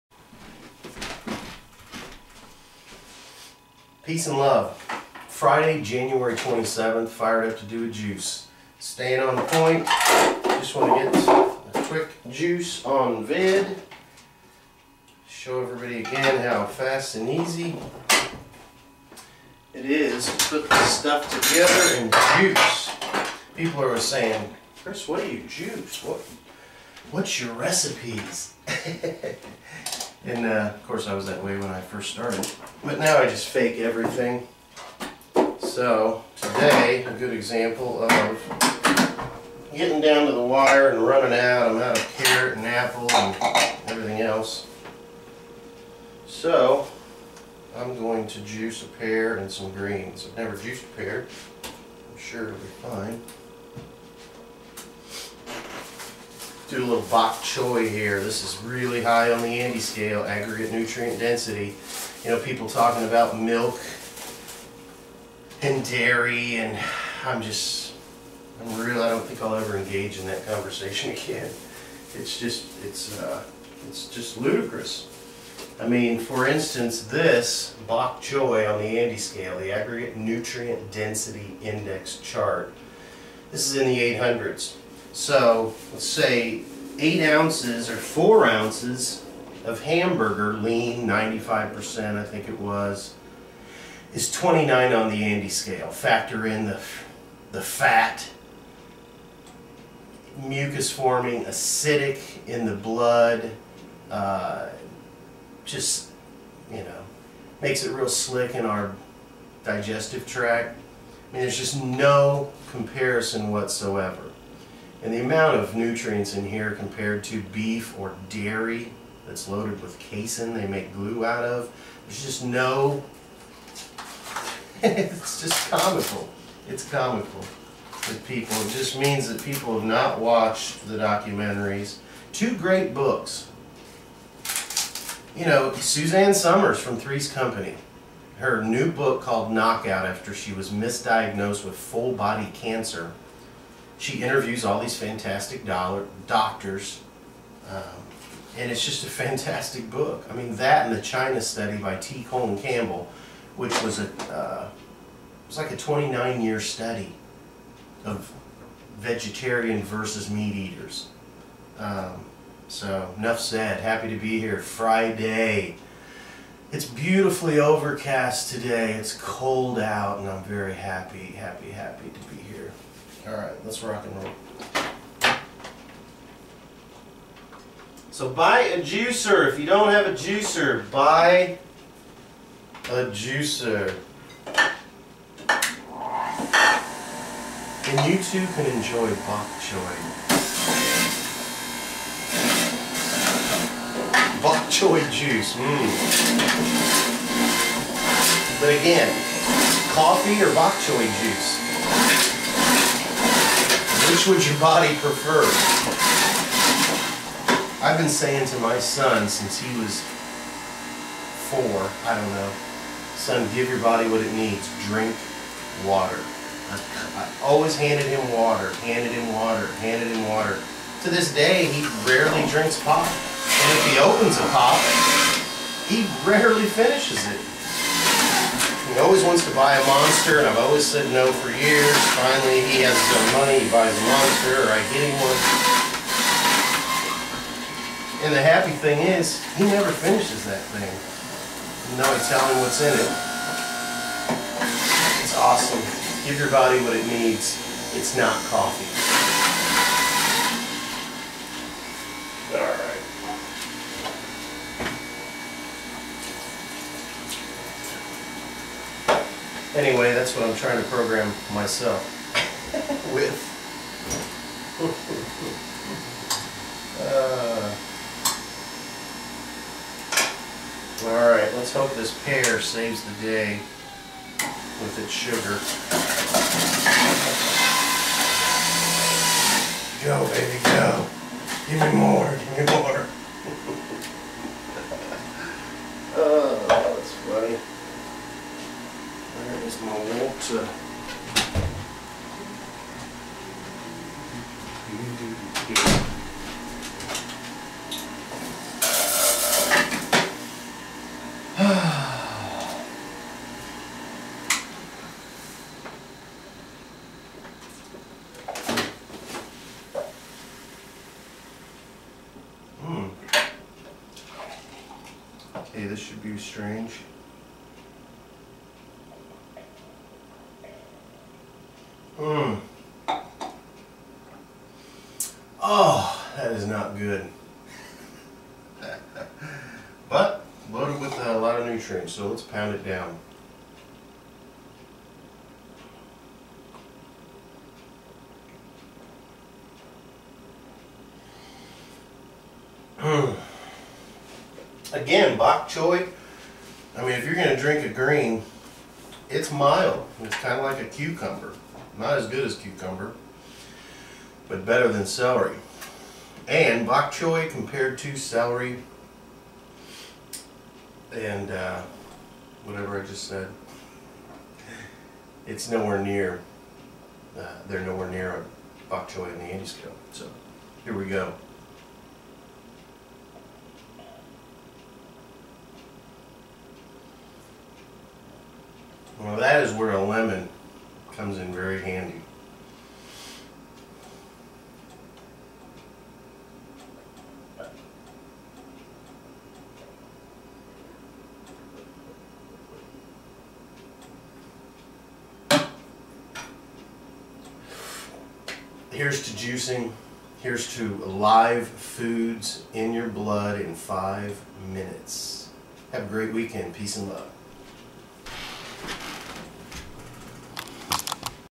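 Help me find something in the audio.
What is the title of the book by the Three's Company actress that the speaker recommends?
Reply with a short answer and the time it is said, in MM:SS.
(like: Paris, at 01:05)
Knockout, at 02:19.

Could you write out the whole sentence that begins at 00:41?
I'm out of carrot and apple and everything else.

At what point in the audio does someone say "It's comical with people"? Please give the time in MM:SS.
02:06.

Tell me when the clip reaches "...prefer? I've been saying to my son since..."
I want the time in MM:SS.
03:24.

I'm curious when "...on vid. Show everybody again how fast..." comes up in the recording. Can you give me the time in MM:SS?
00:12.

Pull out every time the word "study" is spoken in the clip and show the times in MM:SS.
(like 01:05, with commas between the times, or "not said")
02:31, 02:36.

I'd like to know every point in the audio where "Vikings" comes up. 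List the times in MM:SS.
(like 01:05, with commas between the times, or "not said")
not said.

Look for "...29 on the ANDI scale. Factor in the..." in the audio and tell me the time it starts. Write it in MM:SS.
01:34.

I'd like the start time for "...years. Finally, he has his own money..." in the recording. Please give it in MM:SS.
03:51.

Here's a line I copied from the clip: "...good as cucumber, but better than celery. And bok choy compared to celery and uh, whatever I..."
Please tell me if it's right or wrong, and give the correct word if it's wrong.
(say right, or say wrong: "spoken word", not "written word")
right.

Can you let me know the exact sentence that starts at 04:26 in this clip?
uh, Alright, let's hope this pear saves the day with its sugar.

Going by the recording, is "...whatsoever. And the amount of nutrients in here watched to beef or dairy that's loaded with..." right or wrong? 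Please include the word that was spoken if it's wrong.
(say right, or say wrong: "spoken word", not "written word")
wrong: "compared", not "watched".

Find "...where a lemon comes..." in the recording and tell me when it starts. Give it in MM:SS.
06:19.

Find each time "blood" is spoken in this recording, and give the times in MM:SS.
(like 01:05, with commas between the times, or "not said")
01:42, 06:43.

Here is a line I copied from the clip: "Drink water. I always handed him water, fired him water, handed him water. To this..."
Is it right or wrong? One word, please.
wrong.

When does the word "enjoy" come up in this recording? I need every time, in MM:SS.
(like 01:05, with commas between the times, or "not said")
03:08.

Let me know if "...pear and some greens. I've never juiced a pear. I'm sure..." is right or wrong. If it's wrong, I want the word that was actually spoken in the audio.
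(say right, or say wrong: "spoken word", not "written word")
right.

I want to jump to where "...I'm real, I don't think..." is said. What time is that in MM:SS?
01:08.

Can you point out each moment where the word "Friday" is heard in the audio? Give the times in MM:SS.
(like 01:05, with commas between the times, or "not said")
00:05, 02:44.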